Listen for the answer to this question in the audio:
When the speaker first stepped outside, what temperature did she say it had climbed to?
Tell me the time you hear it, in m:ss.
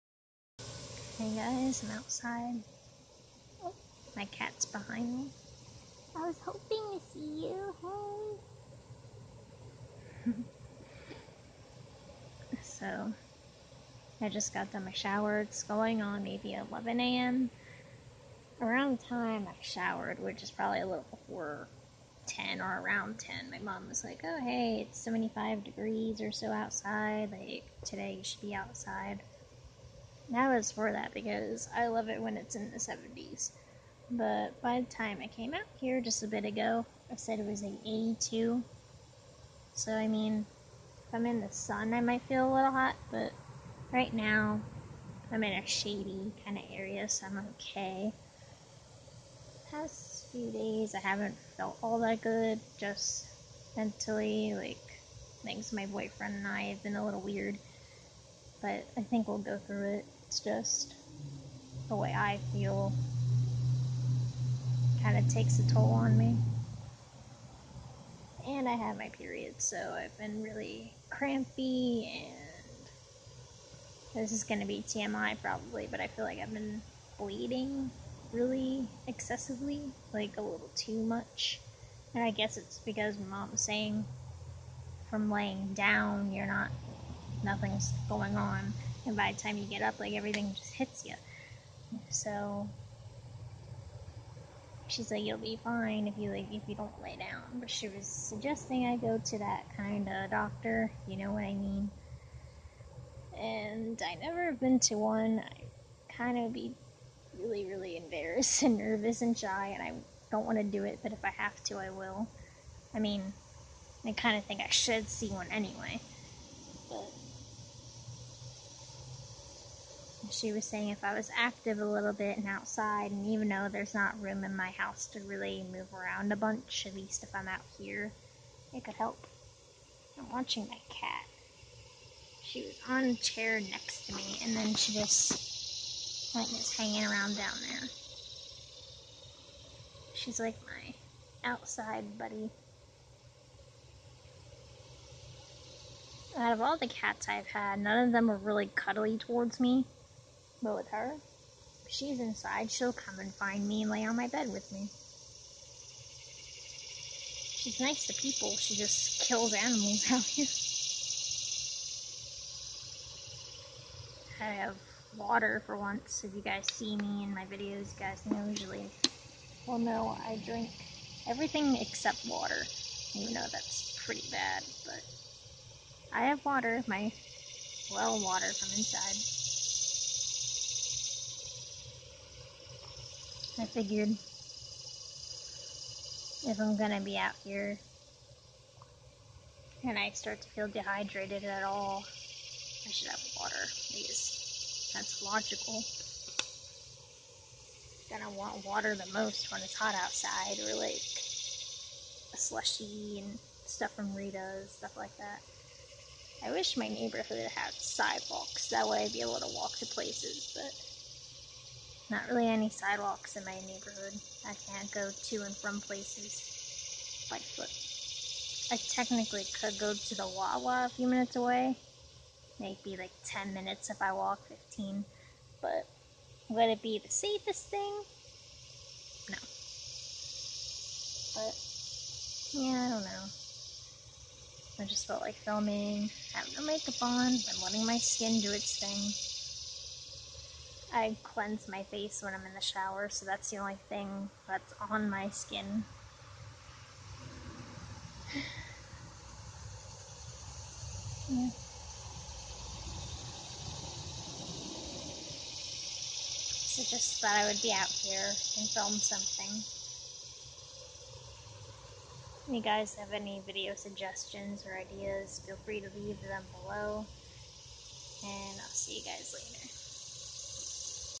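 0:37.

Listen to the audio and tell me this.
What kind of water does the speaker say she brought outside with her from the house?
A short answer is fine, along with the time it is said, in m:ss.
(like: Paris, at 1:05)
Well water, at 2:57.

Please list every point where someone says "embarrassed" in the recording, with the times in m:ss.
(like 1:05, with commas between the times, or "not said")
1:47.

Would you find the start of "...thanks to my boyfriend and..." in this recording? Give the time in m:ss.
0:55.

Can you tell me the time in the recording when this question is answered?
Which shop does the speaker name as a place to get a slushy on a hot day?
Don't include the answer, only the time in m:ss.
3:24.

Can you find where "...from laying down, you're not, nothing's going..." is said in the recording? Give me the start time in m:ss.
1:25.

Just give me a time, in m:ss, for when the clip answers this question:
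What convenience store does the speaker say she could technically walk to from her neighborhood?
3:40.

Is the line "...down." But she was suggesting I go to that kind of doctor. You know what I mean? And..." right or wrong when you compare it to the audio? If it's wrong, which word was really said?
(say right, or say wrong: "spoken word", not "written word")
right.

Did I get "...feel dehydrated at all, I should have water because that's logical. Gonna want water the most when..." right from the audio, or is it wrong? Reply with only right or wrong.
right.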